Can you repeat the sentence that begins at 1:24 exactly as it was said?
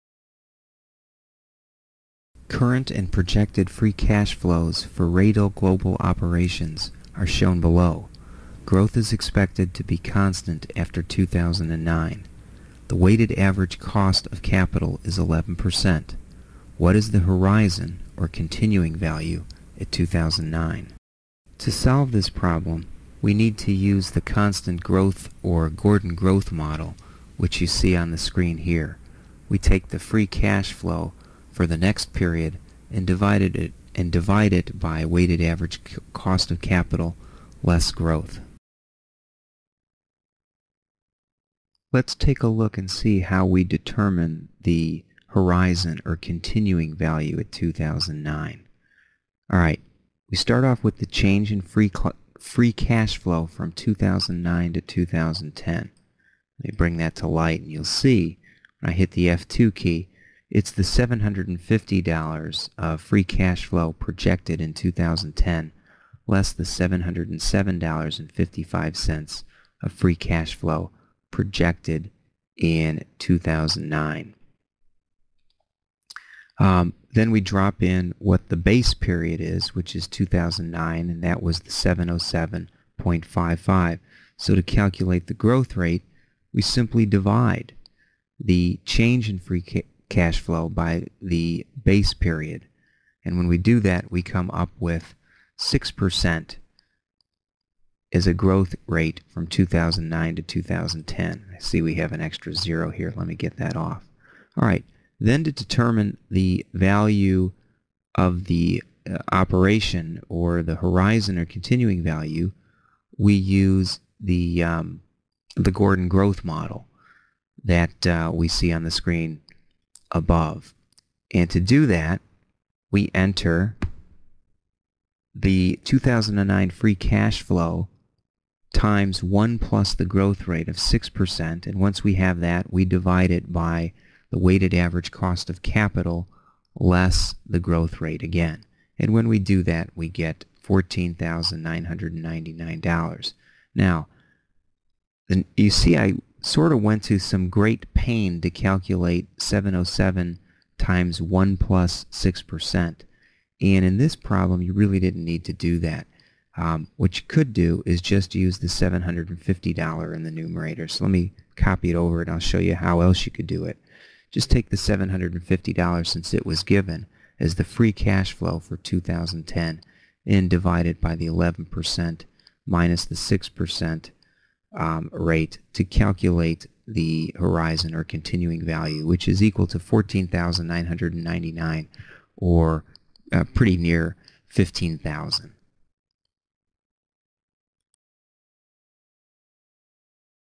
So to calculate the growth rate, we simply divide the change in free cash flow by the base period.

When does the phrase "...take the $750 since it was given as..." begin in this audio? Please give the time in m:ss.
2:44.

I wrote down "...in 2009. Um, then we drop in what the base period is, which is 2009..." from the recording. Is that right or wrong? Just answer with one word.
right.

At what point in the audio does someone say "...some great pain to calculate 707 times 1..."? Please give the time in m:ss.
2:27.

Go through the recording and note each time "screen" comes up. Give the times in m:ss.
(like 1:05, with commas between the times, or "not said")
0:28, 1:58.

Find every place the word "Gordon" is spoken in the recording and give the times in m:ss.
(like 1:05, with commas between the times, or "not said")
0:25, 1:55.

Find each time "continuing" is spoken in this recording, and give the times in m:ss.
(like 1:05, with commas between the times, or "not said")
0:18, 0:46, 1:51, 2:58.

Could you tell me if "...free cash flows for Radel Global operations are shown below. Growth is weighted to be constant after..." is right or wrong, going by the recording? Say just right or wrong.
wrong.